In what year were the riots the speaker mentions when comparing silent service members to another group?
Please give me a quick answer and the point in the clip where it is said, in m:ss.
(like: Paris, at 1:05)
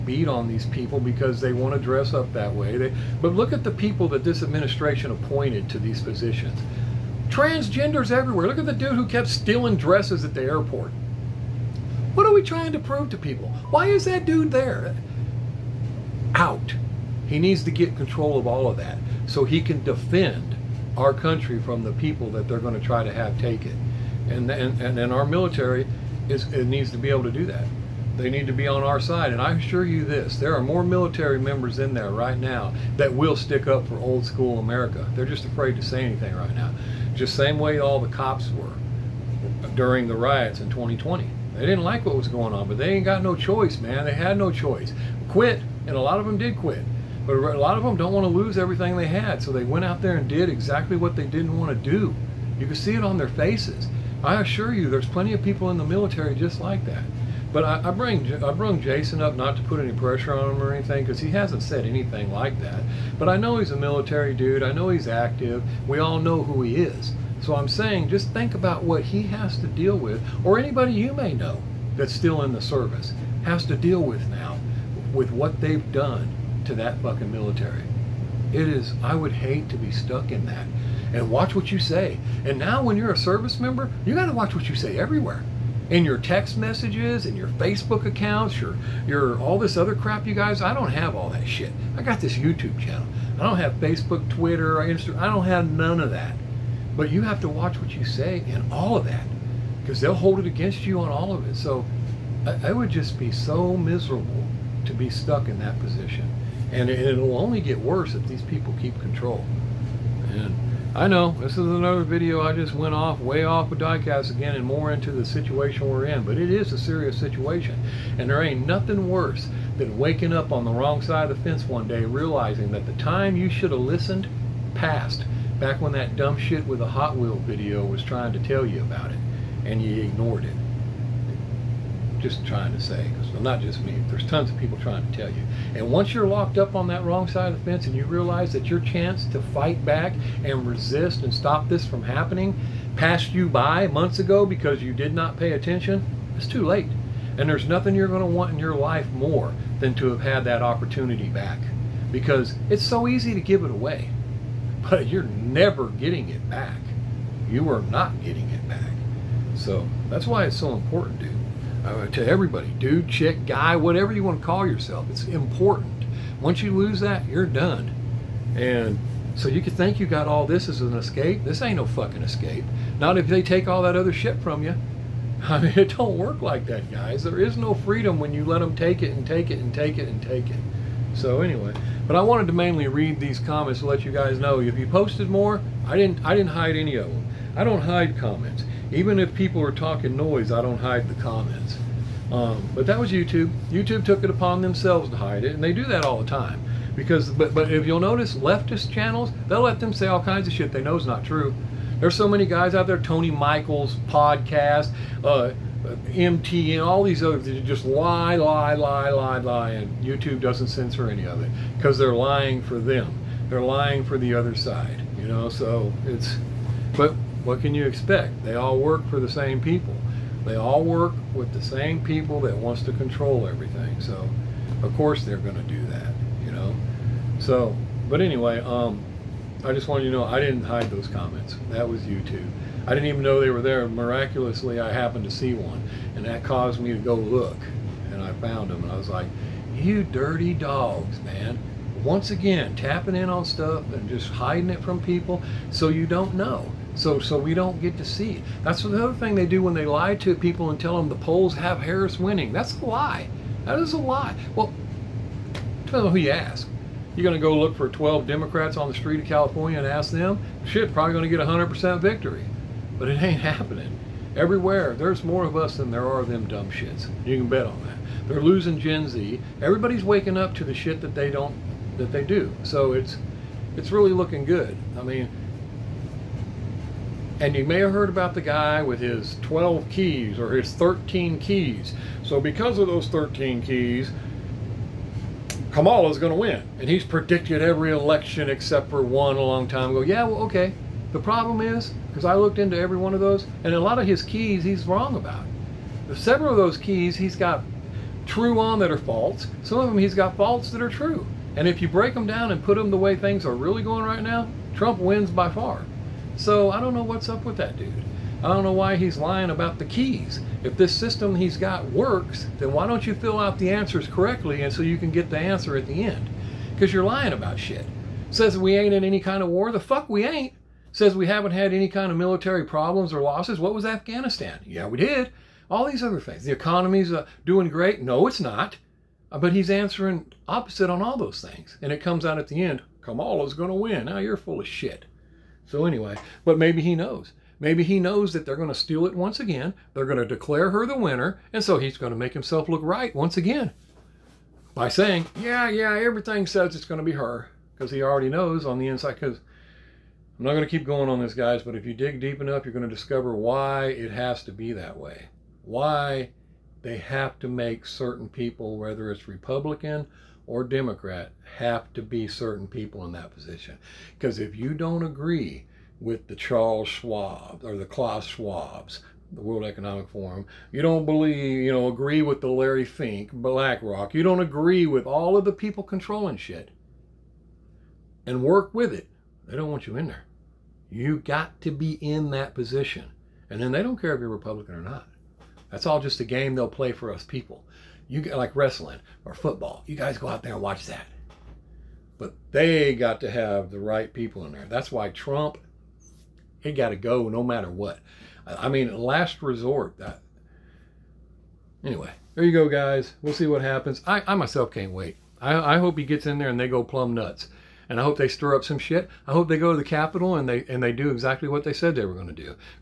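2020, at 0:40.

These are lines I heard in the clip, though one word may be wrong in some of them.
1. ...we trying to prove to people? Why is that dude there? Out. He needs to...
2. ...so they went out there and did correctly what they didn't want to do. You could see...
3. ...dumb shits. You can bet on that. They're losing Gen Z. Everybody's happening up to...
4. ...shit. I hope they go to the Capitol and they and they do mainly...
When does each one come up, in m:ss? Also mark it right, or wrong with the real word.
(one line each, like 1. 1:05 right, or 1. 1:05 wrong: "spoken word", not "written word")
1. 0:12 right
2. 0:49 wrong: "exactly", not "correctly"
3. 4:26 wrong: "waking", not "happening"
4. 6:48 wrong: "exactly", not "mainly".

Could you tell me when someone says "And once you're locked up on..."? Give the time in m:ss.
2:15.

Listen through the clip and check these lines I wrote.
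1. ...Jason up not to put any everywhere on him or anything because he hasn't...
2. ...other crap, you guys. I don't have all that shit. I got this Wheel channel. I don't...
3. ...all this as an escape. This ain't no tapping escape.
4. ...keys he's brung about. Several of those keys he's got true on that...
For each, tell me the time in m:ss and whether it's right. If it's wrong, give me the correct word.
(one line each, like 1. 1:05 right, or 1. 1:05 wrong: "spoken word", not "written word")
1. 0:58 wrong: "pressure", not "everywhere"
2. 1:29 wrong: "YouTube", not "Wheel"
3. 2:50 wrong: "fucking", not "tapping"
4. 4:54 wrong: "wrong", not "brung".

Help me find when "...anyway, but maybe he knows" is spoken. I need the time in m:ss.
5:35.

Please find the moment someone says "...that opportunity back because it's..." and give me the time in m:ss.
2:30.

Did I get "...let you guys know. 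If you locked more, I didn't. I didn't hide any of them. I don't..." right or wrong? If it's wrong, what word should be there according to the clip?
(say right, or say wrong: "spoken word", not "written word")
wrong: "posted", not "locked".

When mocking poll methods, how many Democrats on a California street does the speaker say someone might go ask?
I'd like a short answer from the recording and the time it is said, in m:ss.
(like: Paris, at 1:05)
12, at 4:17.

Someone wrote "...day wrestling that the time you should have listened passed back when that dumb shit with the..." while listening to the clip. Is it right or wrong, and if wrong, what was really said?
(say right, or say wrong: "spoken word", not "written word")
wrong: "realizing", not "wrestling".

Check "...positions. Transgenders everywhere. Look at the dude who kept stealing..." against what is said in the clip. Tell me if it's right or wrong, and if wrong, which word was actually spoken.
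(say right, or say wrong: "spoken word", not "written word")
right.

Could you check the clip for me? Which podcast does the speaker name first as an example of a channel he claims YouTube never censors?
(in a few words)
Tony Michaels podcast.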